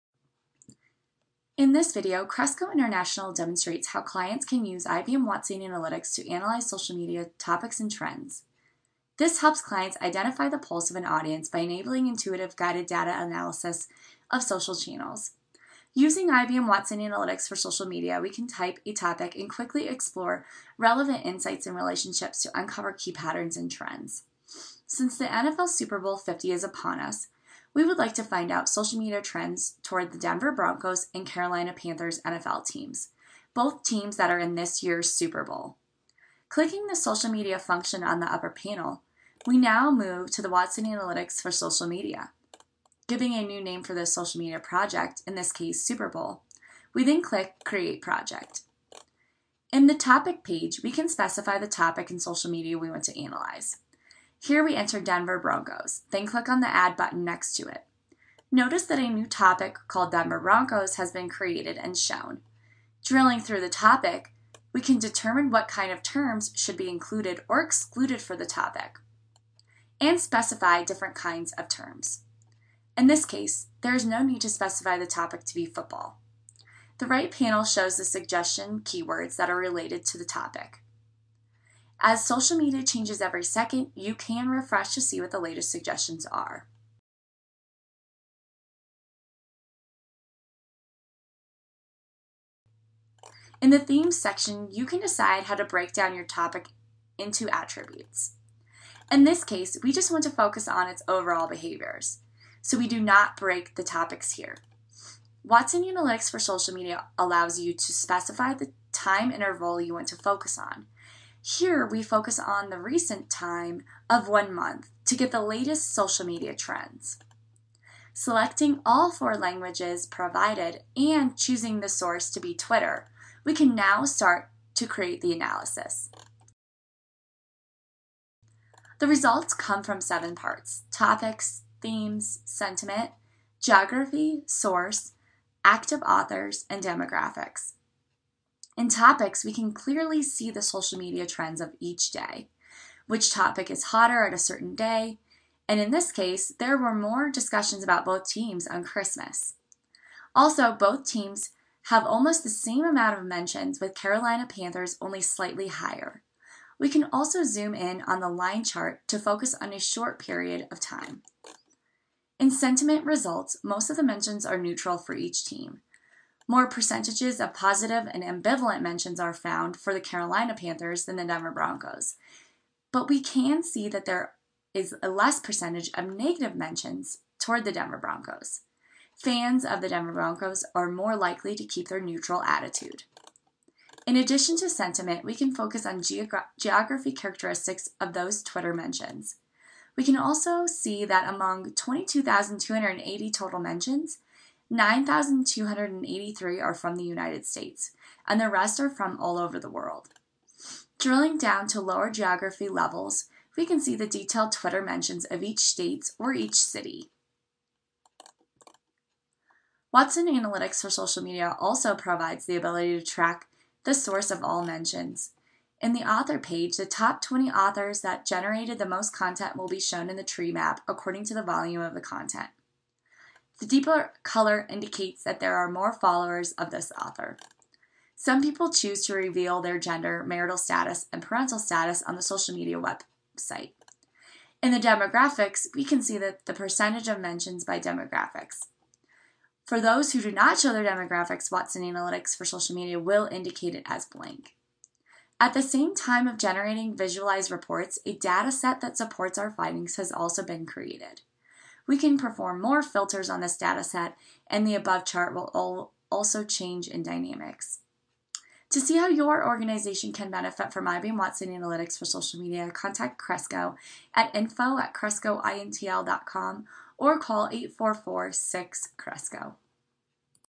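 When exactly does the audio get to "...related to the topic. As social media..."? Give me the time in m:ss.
1:19.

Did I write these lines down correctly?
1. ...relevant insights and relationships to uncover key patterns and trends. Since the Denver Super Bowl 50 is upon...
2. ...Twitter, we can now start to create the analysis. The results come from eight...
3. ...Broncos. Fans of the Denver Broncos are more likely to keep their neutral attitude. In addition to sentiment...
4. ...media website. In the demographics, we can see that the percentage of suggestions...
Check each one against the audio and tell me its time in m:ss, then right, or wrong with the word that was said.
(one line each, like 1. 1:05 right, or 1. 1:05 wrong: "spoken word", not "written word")
1. 0:20 wrong: "NFL", not "Denver"
2. 2:02 wrong: "seven", not "eight"
3. 2:57 right
4. 3:52 wrong: "mentions", not "suggestions".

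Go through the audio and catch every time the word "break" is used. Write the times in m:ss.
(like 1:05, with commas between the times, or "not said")
1:35, 1:43.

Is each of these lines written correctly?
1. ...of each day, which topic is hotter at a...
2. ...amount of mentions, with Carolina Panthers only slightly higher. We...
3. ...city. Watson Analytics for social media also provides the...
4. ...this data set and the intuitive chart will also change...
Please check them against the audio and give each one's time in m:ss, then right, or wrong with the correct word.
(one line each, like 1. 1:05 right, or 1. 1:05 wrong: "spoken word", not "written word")
1. 2:21 right
2. 2:32 right
3. 3:26 right
4. 4:13 wrong: "above", not "intuitive".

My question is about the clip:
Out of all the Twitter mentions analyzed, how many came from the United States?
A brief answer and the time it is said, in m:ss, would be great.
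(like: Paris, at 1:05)
9,283, at 3:14.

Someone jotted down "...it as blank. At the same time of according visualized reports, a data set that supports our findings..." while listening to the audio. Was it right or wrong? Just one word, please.
wrong.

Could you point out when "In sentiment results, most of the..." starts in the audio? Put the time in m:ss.
2:42.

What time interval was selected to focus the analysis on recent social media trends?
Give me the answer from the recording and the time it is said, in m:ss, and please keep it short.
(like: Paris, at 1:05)
one month, at 1:54.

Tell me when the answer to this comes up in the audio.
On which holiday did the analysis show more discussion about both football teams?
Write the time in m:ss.
2:28.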